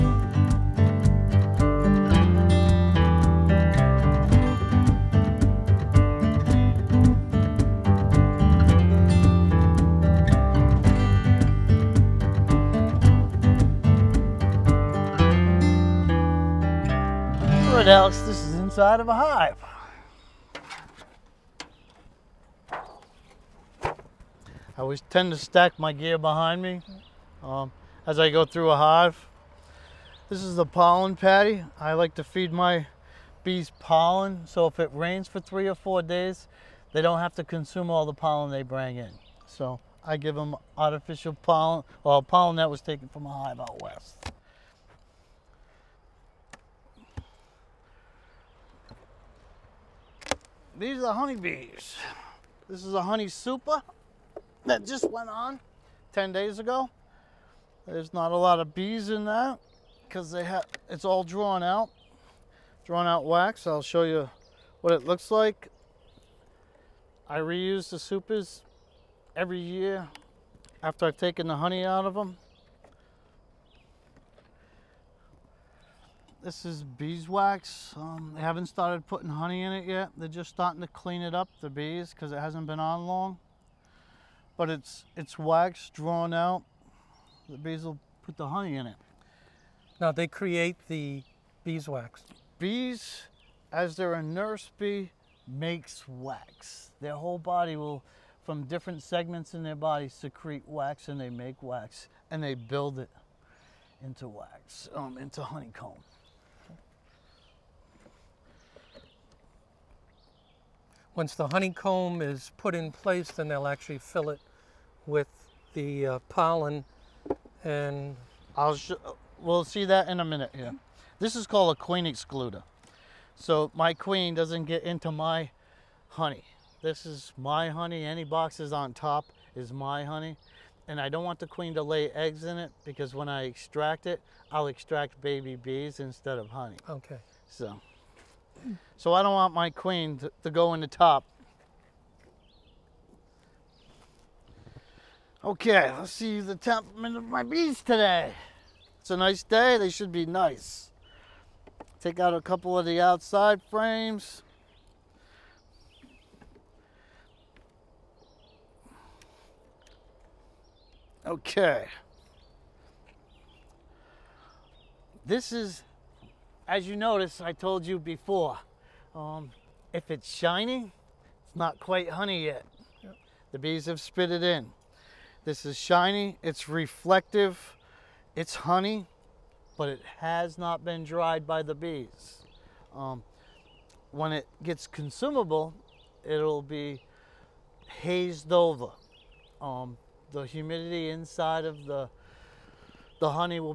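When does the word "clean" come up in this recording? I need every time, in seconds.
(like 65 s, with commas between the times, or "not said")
80 s.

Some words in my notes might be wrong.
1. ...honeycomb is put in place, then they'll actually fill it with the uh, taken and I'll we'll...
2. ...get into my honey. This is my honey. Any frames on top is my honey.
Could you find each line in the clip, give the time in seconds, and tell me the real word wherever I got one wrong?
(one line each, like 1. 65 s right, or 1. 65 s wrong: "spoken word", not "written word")
1. 111 s wrong: "pollen", not "taken"
2. 124 s wrong: "boxes", not "frames".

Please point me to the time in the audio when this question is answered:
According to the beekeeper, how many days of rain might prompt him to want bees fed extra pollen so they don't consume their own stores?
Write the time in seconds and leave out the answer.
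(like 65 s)
35 s.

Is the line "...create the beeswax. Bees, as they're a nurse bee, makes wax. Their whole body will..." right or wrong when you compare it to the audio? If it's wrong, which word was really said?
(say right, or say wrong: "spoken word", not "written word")
right.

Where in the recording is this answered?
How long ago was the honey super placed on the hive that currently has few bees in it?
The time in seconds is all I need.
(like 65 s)
56 s.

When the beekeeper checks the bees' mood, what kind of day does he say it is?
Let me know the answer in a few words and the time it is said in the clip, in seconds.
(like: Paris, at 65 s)
A nice day, at 149 s.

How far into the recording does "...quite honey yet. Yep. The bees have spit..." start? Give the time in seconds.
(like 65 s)
171 s.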